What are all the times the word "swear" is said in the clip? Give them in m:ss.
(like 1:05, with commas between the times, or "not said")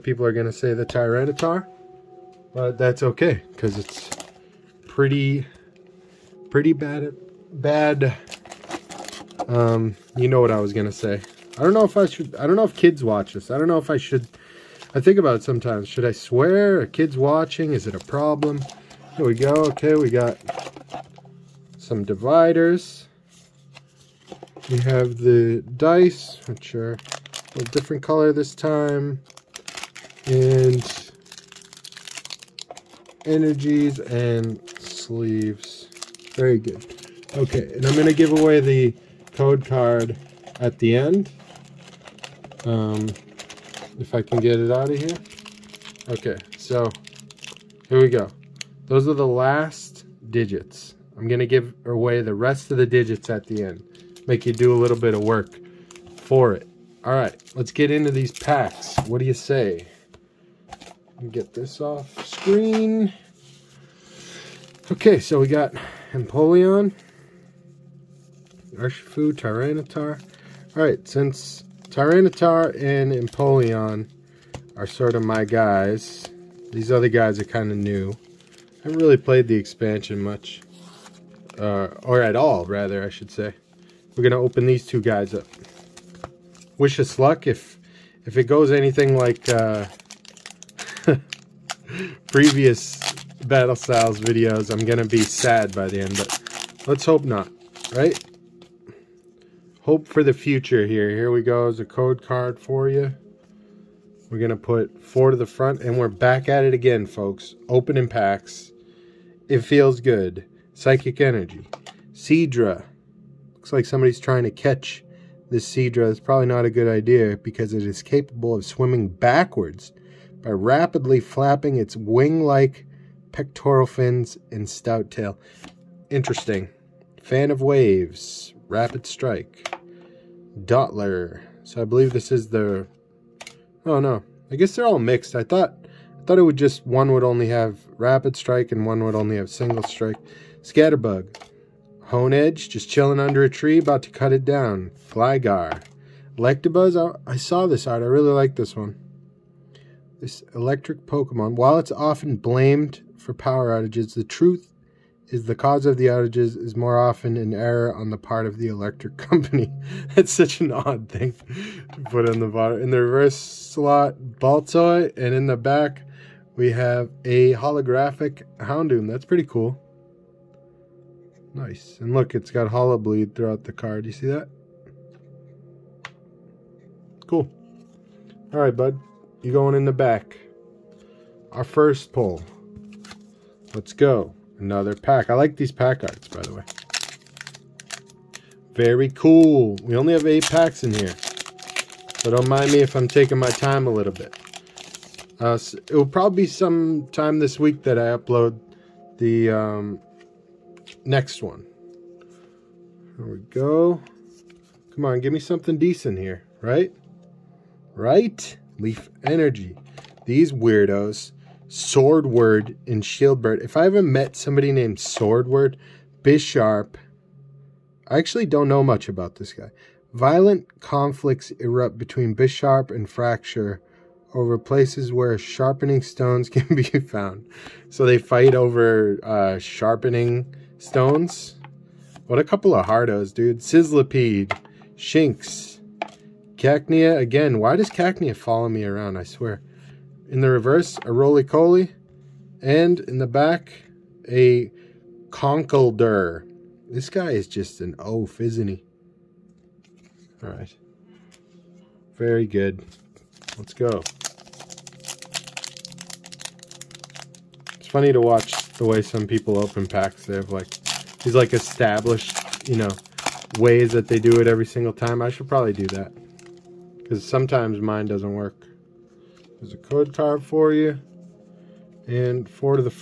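0:16, 3:59.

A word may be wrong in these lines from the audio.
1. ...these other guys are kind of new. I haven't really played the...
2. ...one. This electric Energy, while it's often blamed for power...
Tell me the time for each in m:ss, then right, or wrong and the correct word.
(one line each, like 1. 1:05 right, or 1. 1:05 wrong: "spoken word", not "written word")
1. 1:16 right
2. 2:28 wrong: "Pokemon", not "Energy".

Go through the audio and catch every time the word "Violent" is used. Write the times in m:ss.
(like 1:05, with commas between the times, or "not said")
3:40.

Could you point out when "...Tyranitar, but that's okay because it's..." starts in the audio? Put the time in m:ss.
0:00.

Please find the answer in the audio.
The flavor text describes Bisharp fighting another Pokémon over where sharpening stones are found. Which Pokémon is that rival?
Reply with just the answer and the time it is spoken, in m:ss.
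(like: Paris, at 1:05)
Fraxure, at 3:43.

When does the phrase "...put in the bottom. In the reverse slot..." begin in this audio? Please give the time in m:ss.
2:42.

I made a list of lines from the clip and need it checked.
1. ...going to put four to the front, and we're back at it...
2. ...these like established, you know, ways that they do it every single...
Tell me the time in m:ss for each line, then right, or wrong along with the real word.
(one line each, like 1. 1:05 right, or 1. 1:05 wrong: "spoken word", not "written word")
1. 1:44 right
2. 4:21 right.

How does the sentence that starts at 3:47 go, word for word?
So they fight over uh, sharpening Stones.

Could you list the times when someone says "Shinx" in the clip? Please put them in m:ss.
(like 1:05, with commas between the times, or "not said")
3:54.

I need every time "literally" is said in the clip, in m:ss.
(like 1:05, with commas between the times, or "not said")
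not said.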